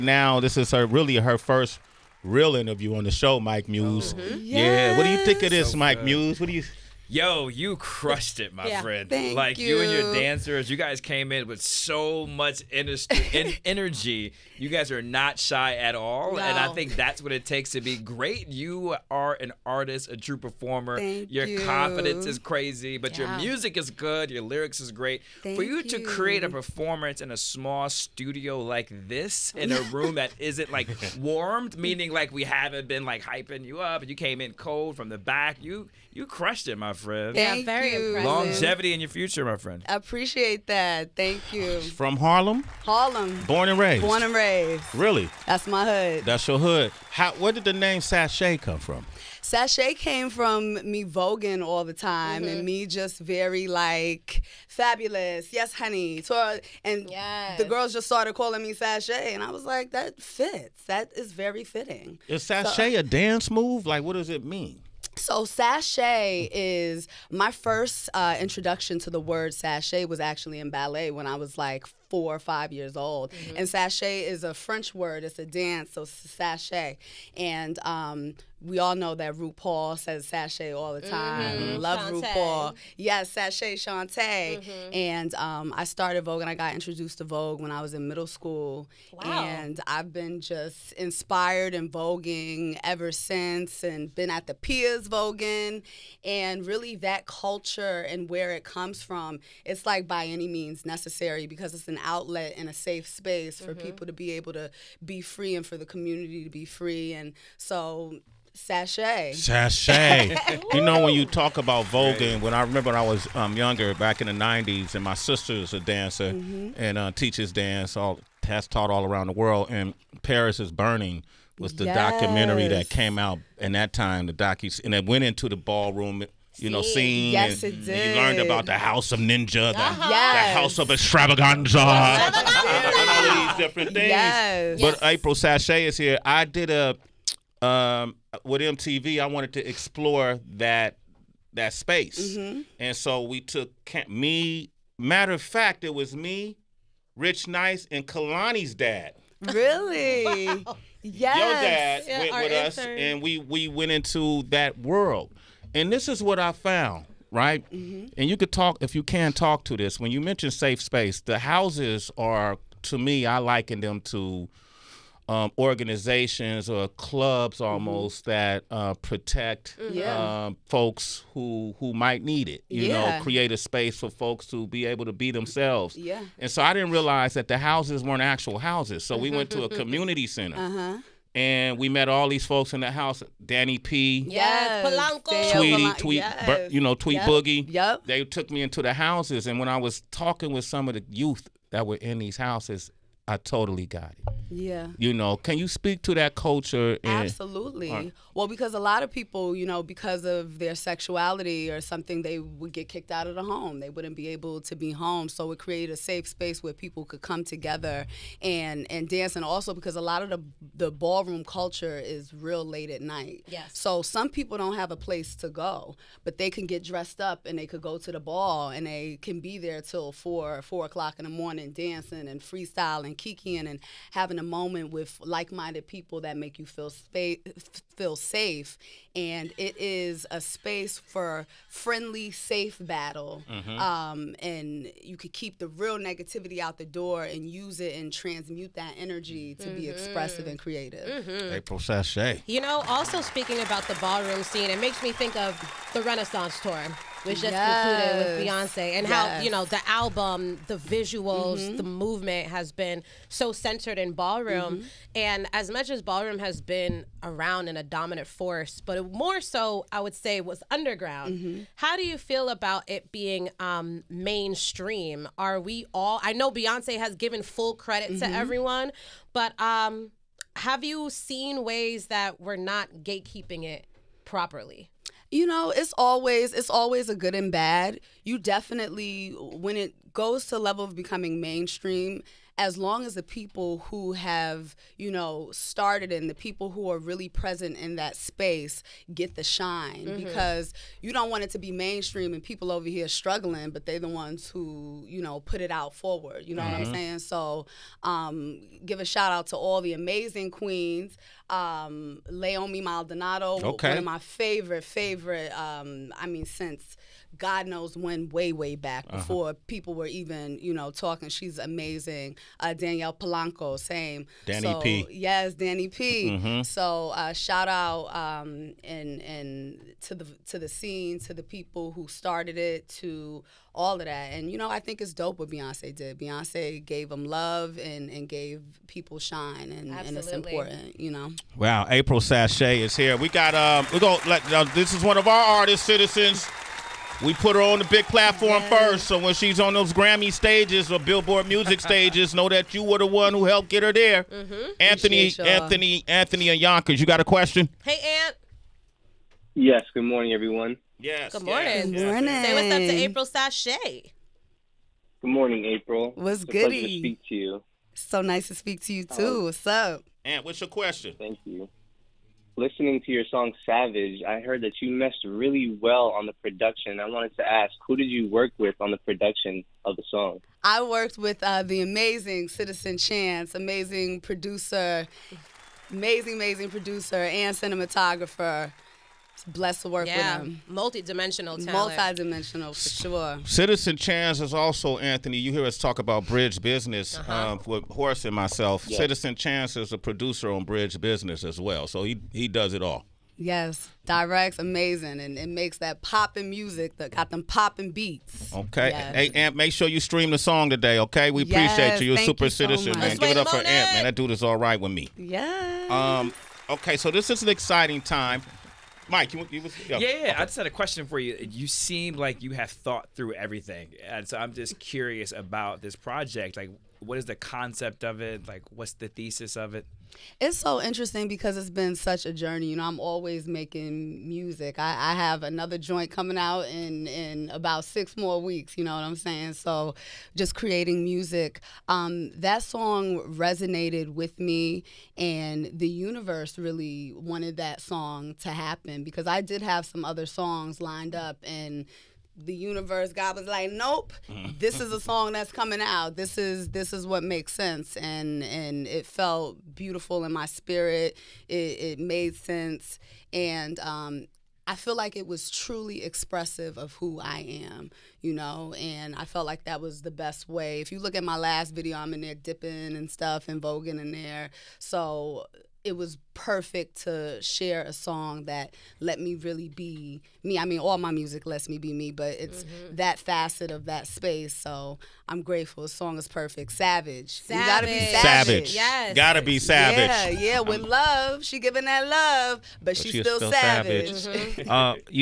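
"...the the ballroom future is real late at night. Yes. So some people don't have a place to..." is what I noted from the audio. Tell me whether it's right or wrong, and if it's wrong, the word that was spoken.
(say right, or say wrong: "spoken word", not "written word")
wrong: "culture", not "future".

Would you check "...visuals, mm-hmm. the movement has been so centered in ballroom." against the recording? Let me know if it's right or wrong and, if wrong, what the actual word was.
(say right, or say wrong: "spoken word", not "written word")
right.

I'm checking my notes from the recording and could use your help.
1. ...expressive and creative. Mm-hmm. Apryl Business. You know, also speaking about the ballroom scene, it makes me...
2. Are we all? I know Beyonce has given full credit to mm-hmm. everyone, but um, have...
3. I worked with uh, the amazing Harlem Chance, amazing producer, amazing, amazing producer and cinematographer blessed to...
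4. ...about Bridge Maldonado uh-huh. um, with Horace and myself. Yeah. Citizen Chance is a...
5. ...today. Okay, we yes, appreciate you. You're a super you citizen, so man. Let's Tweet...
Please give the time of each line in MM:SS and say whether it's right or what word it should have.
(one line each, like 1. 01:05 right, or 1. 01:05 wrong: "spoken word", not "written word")
1. 03:59 wrong: "Sashay", not "Business"
2. 04:25 right
3. 06:10 wrong: "Citizen", not "Harlem"
4. 06:25 wrong: "Business", not "Maldonado"
5. 06:40 wrong: "Give", not "Tweet".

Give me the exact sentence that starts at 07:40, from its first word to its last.
If you look at my last video, I'm in there dipping and stuff and voguing in there.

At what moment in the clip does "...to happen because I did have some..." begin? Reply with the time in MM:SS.
07:18.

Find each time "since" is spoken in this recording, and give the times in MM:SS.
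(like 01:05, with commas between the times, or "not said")
01:33, 05:06.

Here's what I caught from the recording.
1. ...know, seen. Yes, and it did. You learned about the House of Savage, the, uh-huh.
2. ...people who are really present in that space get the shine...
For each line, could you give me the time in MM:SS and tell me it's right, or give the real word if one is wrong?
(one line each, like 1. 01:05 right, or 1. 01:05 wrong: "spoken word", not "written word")
1. 02:06 wrong: "Ninja", not "Savage"
2. 04:46 right.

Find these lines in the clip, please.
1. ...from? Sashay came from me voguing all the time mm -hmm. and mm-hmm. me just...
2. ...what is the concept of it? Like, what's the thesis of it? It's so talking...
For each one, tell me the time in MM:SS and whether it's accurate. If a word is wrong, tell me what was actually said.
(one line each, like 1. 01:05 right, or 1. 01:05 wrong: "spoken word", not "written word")
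1. 00:48 right
2. 06:57 wrong: "interesting", not "talking".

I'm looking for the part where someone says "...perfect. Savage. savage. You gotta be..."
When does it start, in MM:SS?
07:56.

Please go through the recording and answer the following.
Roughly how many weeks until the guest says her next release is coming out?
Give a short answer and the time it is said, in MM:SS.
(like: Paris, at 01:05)
6, at 07:07.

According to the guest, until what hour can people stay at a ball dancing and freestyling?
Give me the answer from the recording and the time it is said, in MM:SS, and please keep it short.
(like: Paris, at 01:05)
4 o'clock in the morning, at 03:40.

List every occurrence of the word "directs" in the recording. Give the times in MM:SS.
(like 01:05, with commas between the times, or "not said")
06:34.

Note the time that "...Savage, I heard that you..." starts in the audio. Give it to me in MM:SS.
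06:03.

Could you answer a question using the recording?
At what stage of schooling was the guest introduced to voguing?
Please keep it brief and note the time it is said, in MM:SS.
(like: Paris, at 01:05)
middle school, at 01:28.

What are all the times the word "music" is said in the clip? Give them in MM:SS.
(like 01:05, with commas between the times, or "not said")
00:23, 05:41, 06:36, 07:04, 07:11, 07:51.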